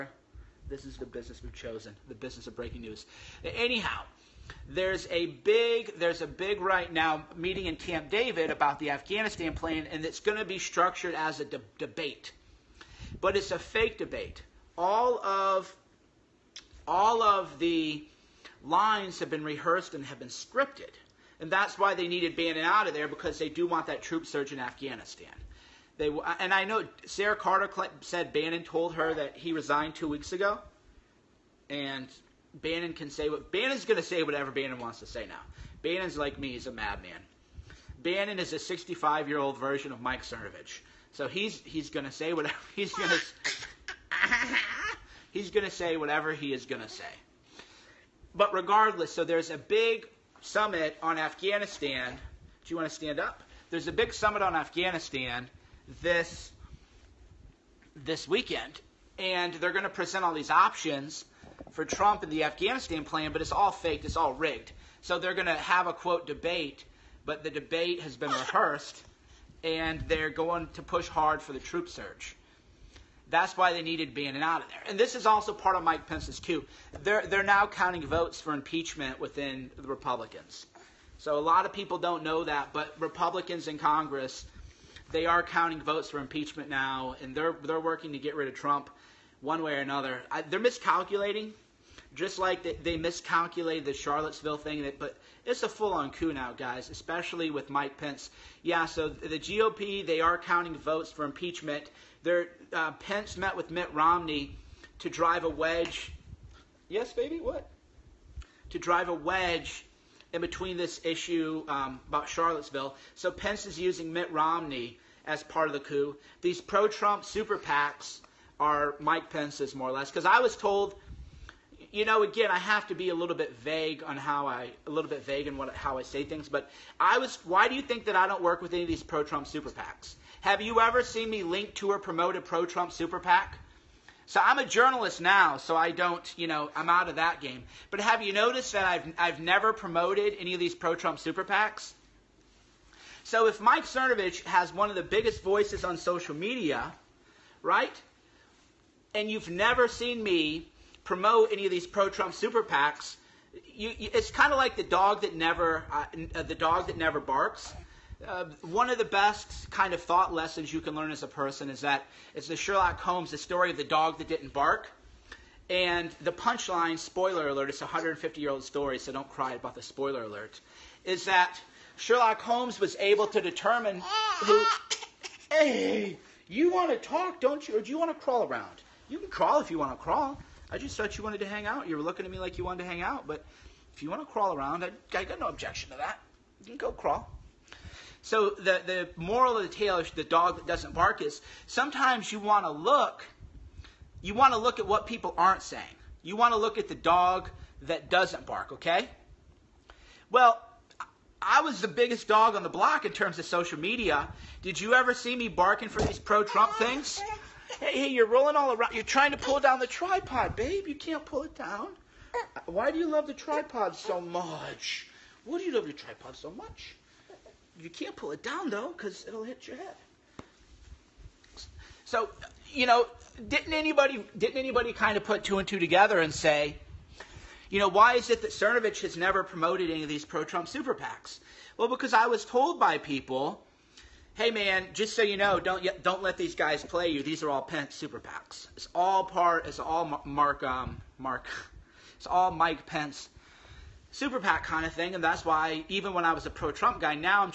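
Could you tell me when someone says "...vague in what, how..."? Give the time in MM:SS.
02:05.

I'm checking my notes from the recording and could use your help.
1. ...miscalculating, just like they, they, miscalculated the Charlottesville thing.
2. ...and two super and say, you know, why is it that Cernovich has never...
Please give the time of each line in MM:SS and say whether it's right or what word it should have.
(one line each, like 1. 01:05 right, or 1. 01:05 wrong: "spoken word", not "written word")
1. 01:30 right
2. 03:45 wrong: "together", not "super".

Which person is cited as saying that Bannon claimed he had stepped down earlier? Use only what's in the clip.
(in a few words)
Sarah Carter.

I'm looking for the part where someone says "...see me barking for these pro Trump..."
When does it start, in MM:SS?
03:25.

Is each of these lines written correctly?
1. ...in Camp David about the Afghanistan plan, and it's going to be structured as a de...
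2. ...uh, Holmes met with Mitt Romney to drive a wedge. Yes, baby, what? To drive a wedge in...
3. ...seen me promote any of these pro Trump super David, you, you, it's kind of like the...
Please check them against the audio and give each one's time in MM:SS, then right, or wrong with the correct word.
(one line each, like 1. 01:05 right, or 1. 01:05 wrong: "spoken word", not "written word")
1. 00:07 right
2. 01:42 wrong: "Pence", not "Holmes"
3. 02:29 wrong: "PACs", not "David".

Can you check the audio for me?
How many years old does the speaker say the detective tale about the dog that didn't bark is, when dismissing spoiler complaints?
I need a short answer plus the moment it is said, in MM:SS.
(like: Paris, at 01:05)
150, at 02:47.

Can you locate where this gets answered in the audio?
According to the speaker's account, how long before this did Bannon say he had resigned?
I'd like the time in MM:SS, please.
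00:29.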